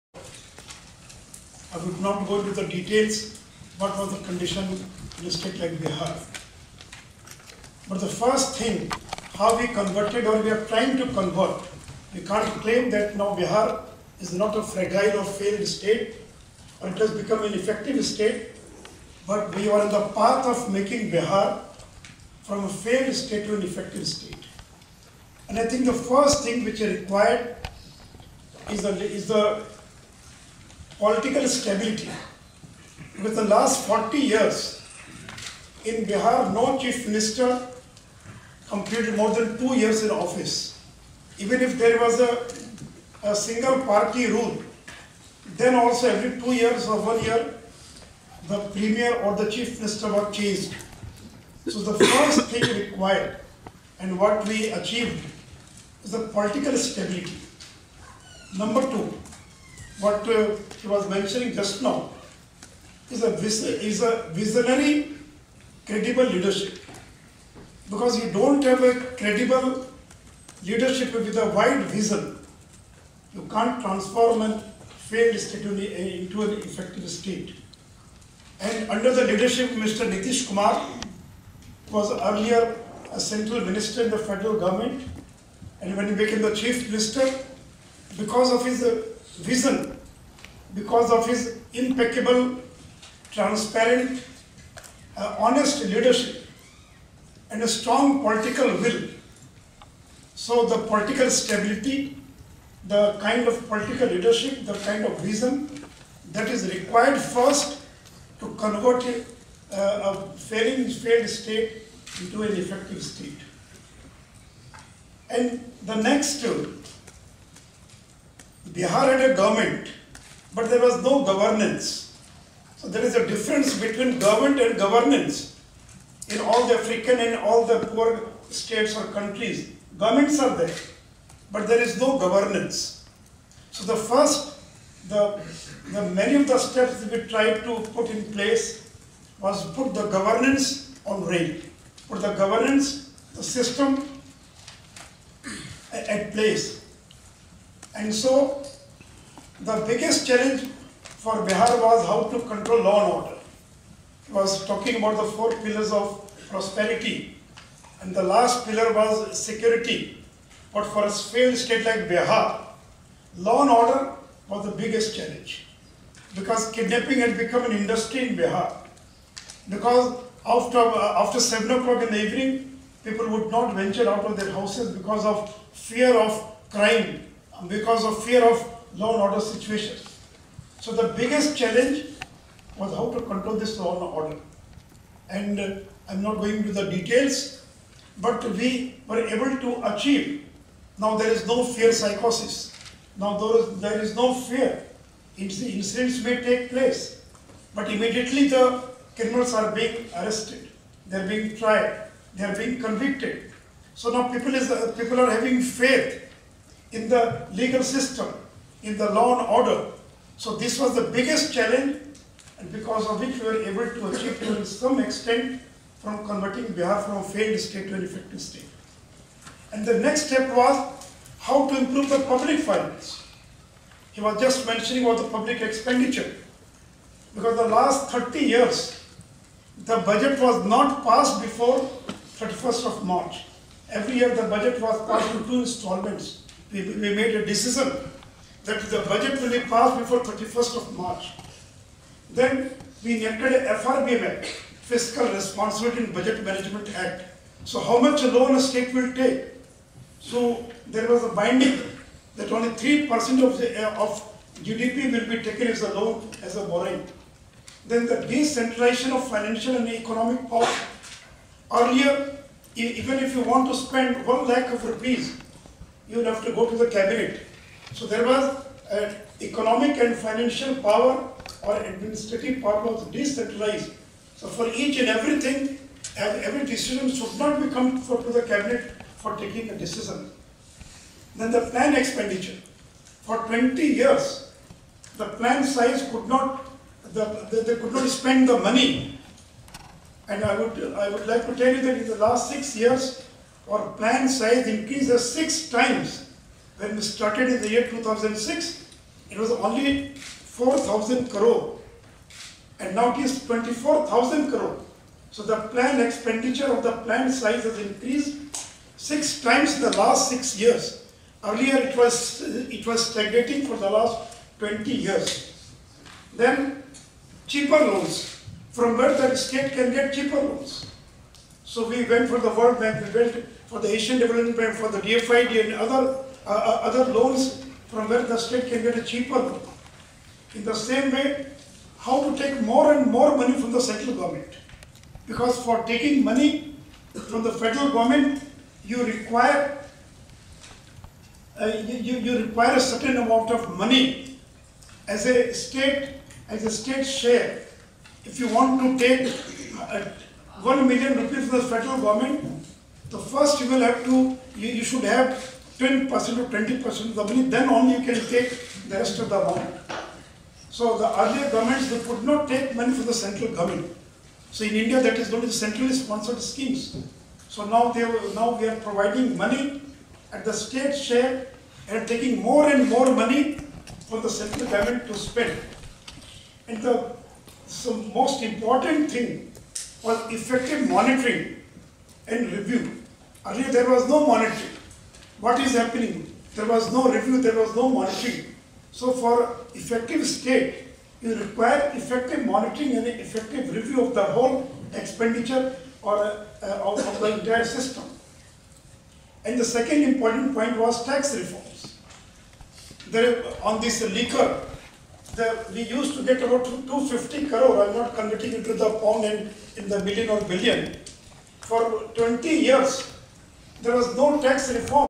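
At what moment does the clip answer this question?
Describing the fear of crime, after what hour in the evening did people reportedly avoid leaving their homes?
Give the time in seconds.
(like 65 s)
171 s.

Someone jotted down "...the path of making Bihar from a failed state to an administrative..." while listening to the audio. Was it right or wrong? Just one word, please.
wrong.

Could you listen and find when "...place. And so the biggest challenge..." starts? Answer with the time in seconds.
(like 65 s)
146 s.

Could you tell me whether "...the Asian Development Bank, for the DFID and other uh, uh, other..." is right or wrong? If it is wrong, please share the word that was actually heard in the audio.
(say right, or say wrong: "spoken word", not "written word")
right.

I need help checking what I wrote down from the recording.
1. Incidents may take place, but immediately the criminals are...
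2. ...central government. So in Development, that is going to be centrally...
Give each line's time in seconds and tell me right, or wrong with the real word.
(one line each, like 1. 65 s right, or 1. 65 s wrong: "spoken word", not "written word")
1. 195 s right
2. 363 s wrong: "India", not "Development".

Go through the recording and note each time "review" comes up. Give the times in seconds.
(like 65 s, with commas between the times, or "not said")
382 s, 387 s, 393 s.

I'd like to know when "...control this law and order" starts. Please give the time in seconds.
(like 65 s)
183 s.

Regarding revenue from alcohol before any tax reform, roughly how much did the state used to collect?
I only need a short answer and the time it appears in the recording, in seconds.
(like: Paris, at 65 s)
250 crore, at 406 s.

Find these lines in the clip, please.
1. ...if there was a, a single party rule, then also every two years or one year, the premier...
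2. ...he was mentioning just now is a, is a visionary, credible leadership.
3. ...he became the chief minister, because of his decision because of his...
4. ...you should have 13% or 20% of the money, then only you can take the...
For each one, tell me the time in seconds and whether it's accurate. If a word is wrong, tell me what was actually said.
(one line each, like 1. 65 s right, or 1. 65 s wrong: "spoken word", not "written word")
1. 41 s right
2. 60 s right
3. 86 s wrong: "vision", not "decision"
4. 354 s wrong: "10", not "13".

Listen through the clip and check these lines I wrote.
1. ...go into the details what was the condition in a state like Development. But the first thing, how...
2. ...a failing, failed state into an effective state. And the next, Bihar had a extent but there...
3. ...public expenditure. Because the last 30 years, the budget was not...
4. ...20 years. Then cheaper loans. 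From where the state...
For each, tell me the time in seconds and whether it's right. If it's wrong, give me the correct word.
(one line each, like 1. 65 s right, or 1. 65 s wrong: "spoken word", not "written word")
1. 2 s wrong: "Bihar", not "Development"
2. 110 s wrong: "government", not "extent"
3. 225 s right
4. 314 s right.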